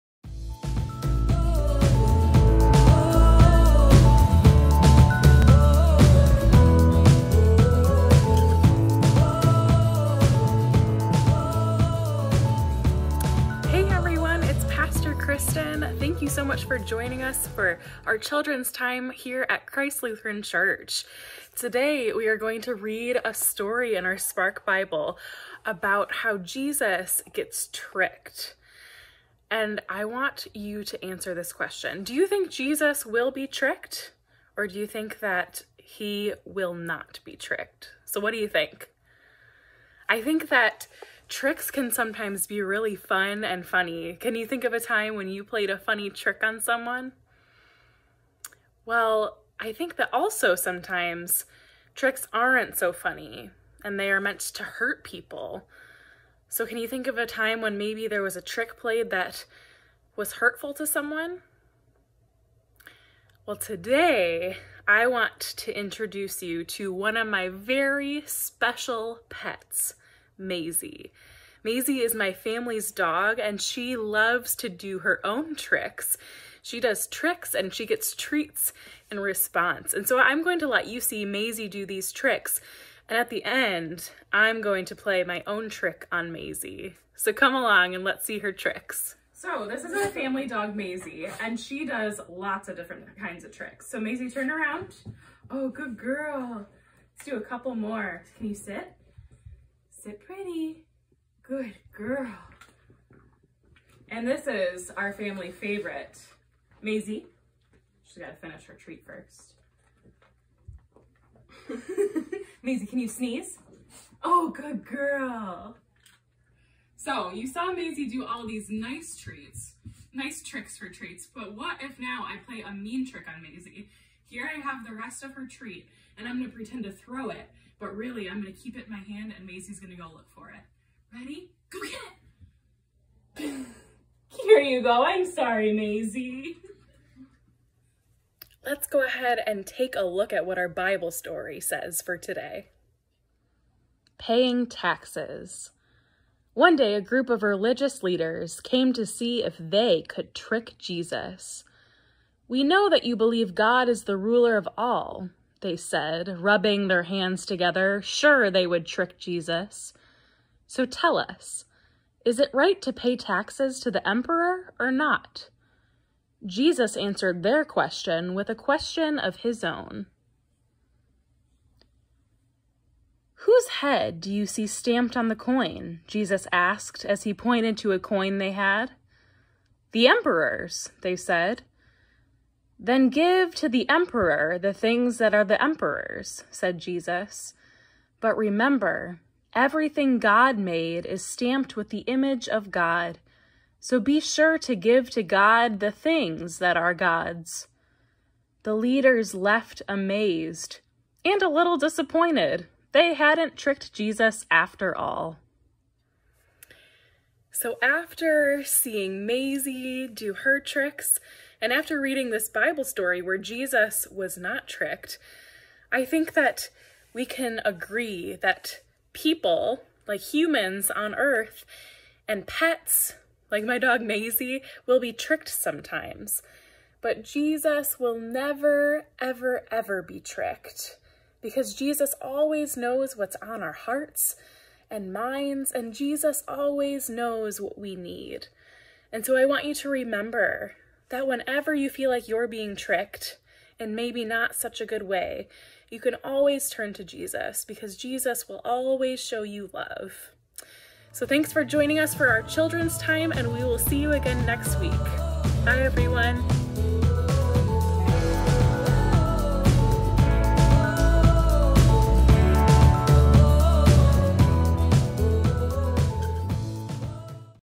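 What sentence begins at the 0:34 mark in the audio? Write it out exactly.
Or do you think that he will not be tricked?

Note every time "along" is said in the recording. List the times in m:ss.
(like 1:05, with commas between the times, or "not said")
1:27.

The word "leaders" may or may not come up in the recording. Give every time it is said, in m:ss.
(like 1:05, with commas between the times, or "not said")
2:28, 3:18.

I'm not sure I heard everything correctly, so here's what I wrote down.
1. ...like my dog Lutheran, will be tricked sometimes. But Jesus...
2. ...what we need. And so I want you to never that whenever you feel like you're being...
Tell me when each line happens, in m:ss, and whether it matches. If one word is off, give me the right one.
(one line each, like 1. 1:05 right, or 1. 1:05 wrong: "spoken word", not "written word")
1. 3:43 wrong: "Maisie", not "Lutheran"
2. 3:57 wrong: "remember", not "never".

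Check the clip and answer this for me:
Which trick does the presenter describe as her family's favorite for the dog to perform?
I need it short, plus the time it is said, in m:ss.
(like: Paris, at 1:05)
Sneeze, at 1:53.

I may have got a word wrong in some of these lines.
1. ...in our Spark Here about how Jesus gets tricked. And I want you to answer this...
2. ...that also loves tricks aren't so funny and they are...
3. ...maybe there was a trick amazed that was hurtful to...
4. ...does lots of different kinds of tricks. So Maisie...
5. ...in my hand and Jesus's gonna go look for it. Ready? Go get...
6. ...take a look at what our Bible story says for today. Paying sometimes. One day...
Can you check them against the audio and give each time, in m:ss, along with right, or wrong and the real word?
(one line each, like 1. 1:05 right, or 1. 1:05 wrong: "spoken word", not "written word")
1. 0:23 wrong: "Bible", not "Here"
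2. 0:49 wrong: "sometimes", not "loves"
3. 0:57 wrong: "played", not "amazed"
4. 1:31 right
5. 2:08 wrong: "Maisie", not "Jesus"
6. 2:19 wrong: "taxes", not "sometimes".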